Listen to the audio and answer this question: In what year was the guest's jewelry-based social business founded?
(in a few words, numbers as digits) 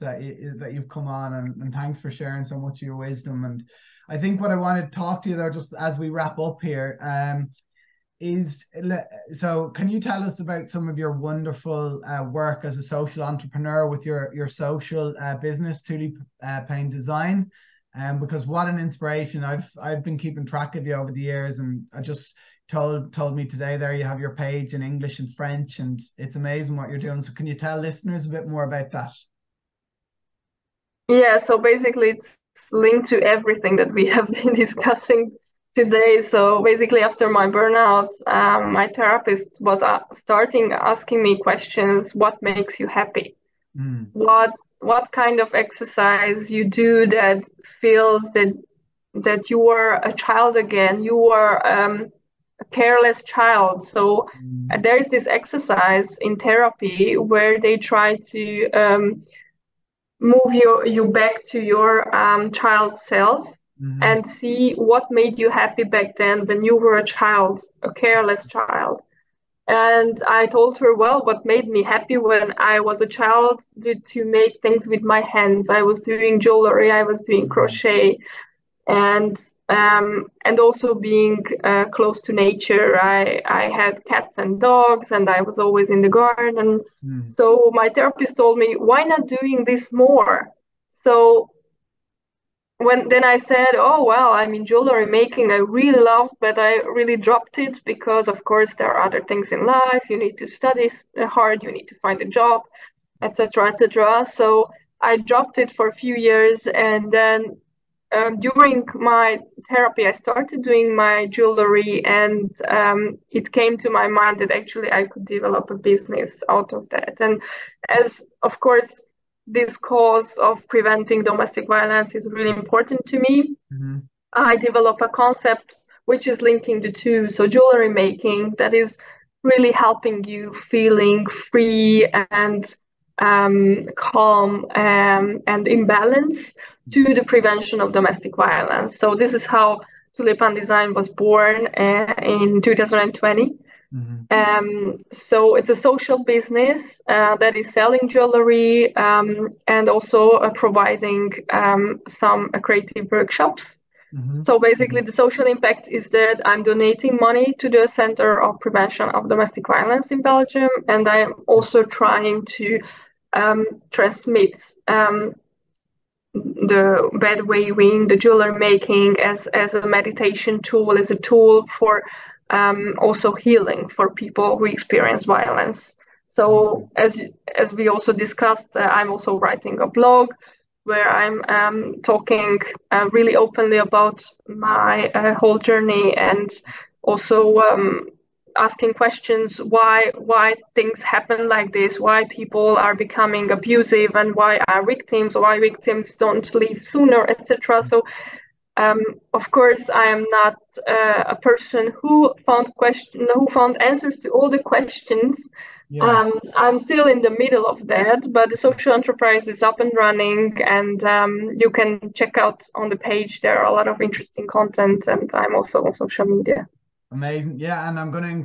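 2020.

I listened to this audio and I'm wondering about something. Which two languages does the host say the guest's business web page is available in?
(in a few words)
English and French.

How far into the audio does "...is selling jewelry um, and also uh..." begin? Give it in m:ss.
2:27.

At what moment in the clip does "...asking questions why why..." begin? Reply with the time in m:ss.
3:08.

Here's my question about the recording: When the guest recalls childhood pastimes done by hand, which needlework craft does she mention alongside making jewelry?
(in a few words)
crochet.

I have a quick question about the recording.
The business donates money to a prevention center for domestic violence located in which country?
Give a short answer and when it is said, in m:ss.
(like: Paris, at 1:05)
Belgium, at 2:40.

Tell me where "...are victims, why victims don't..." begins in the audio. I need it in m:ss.
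3:14.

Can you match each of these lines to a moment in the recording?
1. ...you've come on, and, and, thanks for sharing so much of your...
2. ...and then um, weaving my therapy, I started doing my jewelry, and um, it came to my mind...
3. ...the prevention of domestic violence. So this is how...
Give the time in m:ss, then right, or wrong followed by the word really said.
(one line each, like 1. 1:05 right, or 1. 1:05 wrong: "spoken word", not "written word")
1. 0:00 right
2. 1:46 wrong: "during", not "weaving"
3. 2:17 right.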